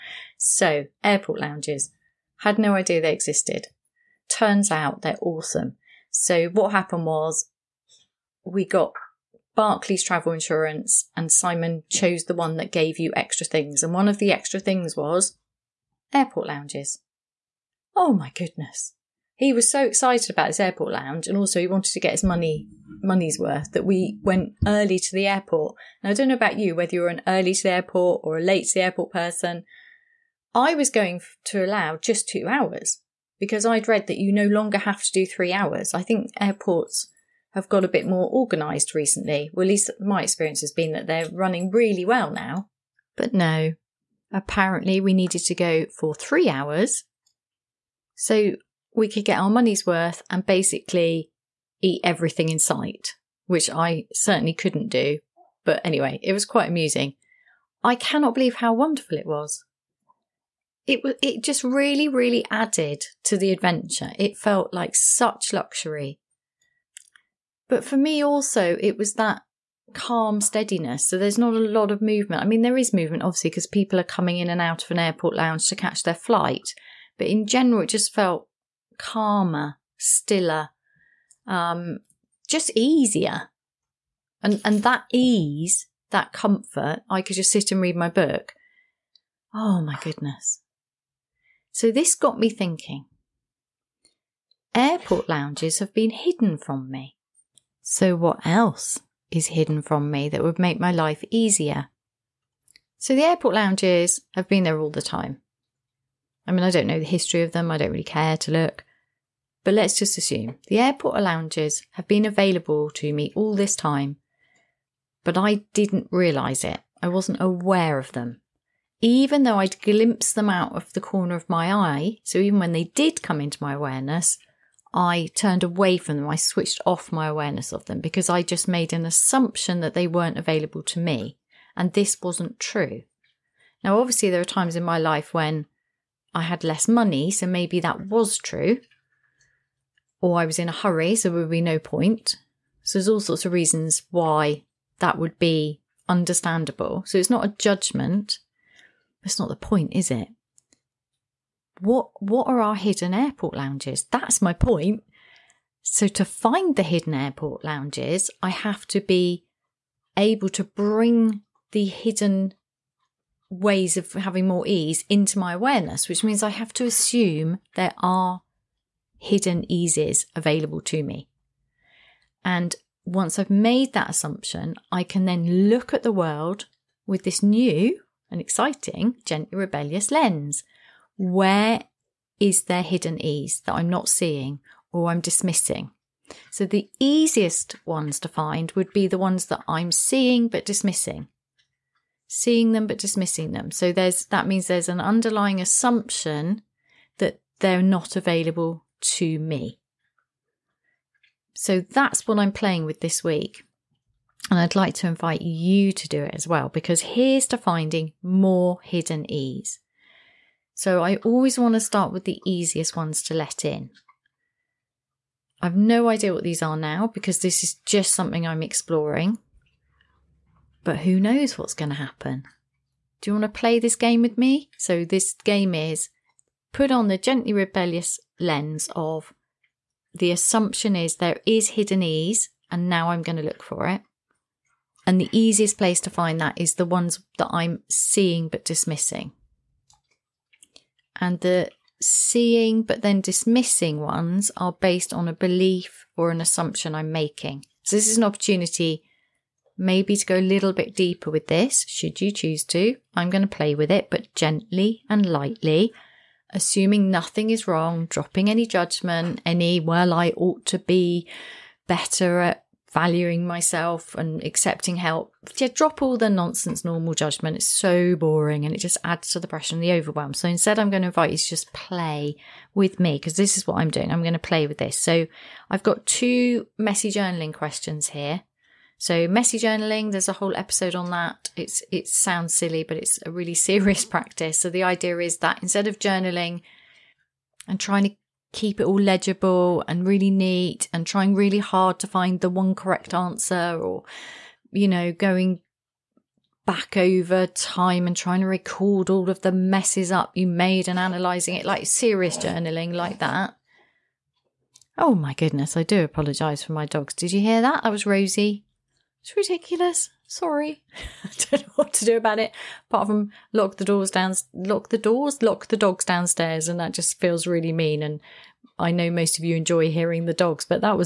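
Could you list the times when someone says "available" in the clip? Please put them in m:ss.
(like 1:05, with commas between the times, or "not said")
1:52, 2:10, 2:50, 3:18.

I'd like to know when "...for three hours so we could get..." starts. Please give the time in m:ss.
0:45.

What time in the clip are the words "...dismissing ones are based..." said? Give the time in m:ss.
4:03.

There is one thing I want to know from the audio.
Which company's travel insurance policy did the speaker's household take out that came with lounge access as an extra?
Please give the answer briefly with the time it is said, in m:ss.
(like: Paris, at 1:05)
Barclays, at 0:09.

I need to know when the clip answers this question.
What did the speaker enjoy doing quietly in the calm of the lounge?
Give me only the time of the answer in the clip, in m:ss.
1:27.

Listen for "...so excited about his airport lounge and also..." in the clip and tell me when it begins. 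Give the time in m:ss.
0:19.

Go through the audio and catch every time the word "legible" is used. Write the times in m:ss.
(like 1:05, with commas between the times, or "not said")
4:49.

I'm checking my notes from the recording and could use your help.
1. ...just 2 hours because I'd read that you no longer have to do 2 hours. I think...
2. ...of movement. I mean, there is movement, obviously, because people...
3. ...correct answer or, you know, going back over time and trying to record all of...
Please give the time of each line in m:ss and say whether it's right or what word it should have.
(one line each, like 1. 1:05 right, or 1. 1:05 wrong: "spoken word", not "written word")
1. 0:31 wrong: "3", not "2"
2. 1:11 right
3. 4:52 right.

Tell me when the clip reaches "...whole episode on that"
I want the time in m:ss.
4:40.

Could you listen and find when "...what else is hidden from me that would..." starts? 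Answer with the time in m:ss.
1:38.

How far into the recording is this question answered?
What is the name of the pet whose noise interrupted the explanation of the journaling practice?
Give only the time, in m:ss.
5:08.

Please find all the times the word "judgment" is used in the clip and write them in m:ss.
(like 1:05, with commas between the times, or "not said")
2:27, 4:18, 4:27.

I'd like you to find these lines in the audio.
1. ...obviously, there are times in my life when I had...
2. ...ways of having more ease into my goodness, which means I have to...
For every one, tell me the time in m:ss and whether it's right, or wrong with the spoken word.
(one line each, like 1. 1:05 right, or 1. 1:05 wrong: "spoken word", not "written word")
1. 2:14 right
2. 2:43 wrong: "awareness", not "goodness".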